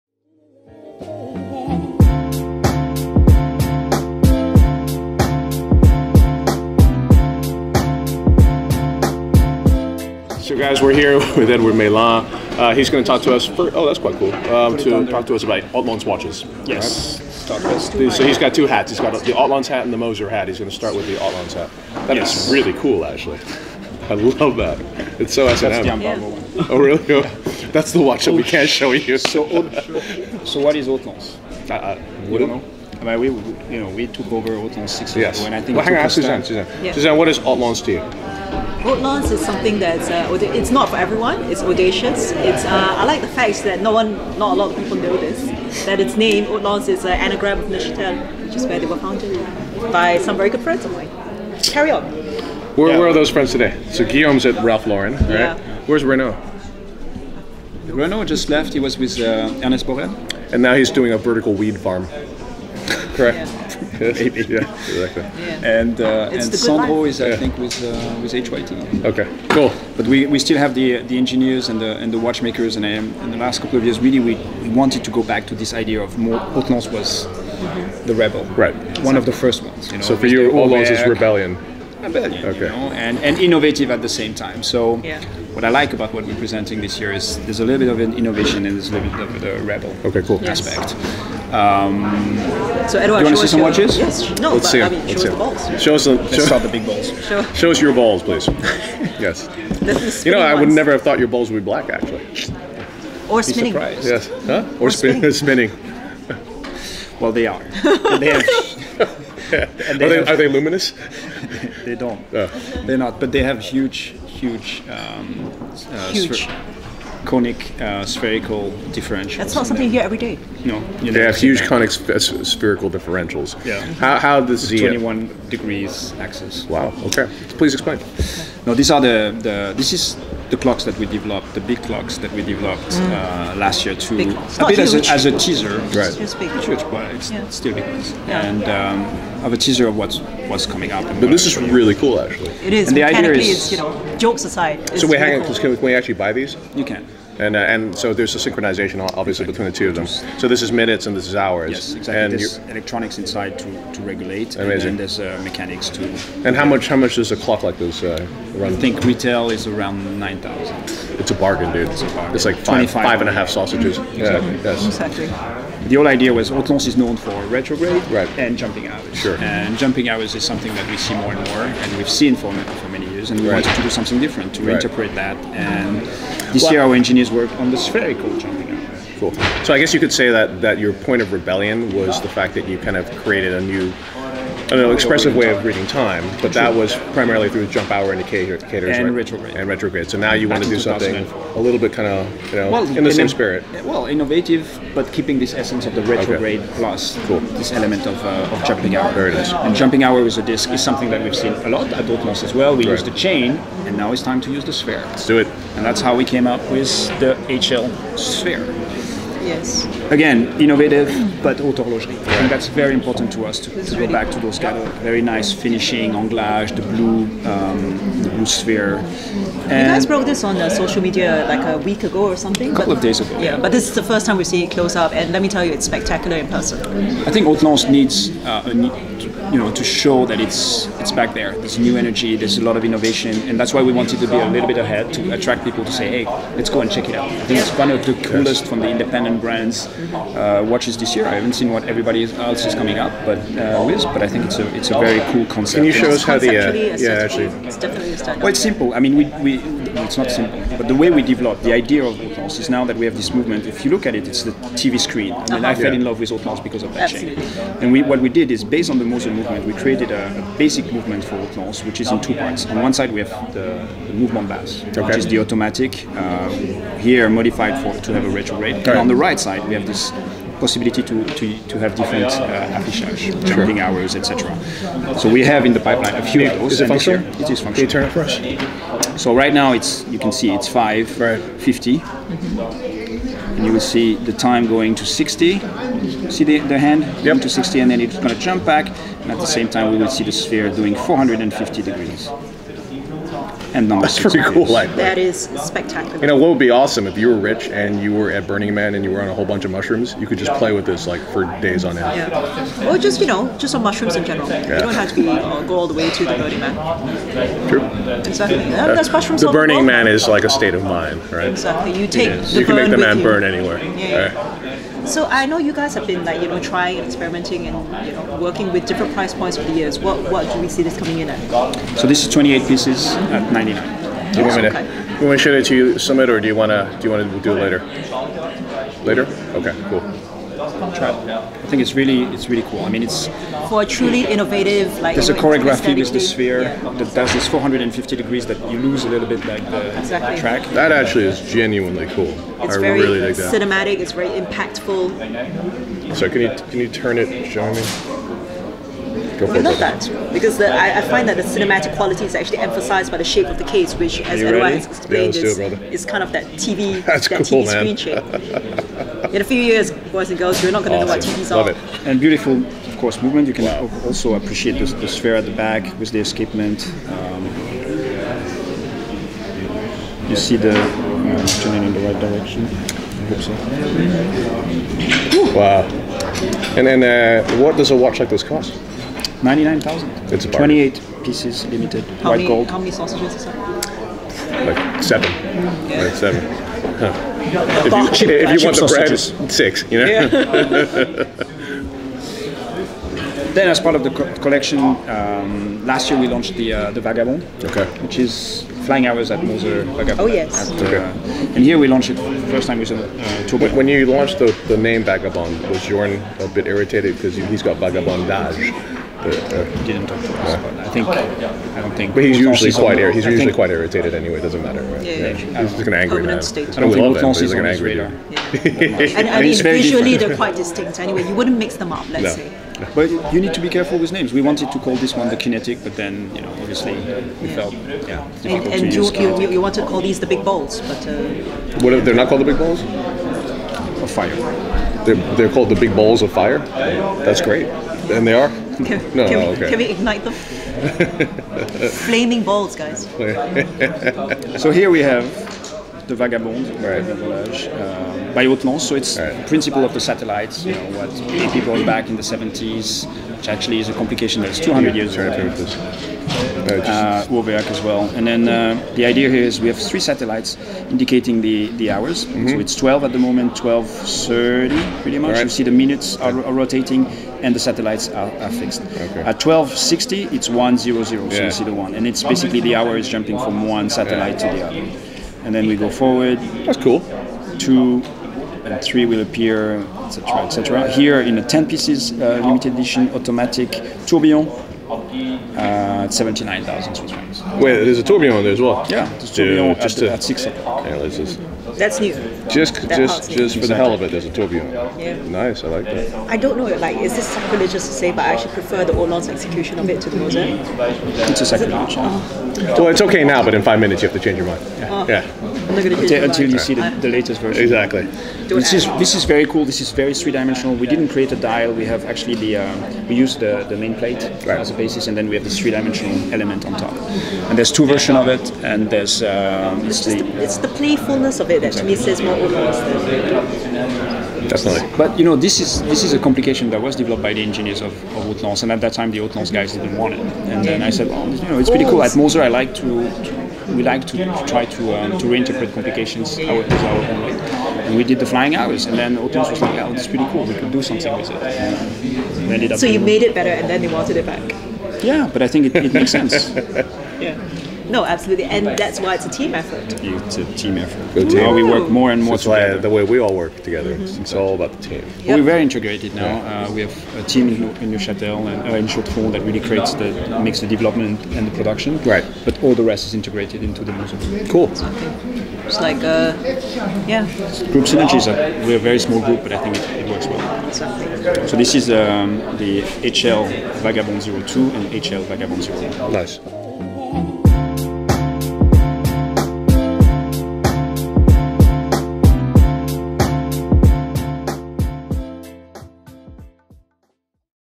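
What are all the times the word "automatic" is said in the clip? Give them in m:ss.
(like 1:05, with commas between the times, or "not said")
4:25, 8:03.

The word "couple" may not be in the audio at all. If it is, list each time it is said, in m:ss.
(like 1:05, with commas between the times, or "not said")
1:13, 3:42.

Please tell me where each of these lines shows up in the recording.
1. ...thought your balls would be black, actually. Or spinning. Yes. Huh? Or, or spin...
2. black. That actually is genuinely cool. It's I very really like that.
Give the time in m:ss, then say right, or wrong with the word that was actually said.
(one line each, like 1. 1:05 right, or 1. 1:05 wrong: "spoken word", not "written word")
1. 1:41 right
2. 5:40 wrong: "track", not "black".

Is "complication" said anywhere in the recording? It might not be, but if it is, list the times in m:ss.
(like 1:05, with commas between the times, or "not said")
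7:33, 8:46, 8:55.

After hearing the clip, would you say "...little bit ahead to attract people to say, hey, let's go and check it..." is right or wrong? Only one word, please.
right.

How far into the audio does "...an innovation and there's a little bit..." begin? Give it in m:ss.
1:27.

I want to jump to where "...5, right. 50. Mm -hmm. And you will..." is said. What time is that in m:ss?
4:40.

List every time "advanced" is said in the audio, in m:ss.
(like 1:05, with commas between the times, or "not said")
not said.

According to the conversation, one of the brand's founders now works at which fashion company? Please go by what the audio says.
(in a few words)
Ralph Lauren.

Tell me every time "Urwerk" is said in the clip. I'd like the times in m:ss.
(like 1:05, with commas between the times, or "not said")
7:37.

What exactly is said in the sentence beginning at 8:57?
And we did the flying hours, and then Otis was like, oh, is pretty cool, we could do something with it.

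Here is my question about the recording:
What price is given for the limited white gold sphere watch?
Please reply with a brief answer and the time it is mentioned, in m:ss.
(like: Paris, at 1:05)
99,000, at 6:19.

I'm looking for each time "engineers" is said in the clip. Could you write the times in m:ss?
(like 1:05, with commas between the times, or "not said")
1:11, 2:56, 8:47.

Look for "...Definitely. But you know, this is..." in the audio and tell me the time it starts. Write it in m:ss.
8:44.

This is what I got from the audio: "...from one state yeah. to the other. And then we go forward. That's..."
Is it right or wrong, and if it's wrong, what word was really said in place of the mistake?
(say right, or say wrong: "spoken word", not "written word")
wrong: "satellite", not "state".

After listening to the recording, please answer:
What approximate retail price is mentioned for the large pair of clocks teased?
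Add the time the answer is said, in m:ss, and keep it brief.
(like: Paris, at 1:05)
9,000, at 2:40.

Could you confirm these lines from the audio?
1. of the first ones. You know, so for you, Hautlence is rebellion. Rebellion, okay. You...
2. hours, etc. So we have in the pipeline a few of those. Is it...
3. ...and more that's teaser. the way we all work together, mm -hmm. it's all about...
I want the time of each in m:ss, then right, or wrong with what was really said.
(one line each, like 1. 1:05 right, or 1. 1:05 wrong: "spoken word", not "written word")
1. 1:19 right
2. 4:33 right
3. 9:12 wrong: "together", not "teaser".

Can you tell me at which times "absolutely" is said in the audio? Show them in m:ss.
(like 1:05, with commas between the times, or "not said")
4:17, 9:08.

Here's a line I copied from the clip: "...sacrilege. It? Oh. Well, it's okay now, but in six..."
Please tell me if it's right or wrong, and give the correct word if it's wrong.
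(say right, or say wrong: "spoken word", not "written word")
wrong: "five", not "six".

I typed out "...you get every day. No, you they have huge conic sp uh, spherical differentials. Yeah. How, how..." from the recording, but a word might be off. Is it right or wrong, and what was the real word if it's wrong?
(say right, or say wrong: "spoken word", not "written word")
right.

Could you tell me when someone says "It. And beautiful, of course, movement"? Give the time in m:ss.
6:01.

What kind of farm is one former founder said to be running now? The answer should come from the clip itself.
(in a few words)
Vertical weed farm.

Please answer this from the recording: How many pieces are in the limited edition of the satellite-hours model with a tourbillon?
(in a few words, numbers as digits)
10.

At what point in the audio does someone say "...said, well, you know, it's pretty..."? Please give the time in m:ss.
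8:50.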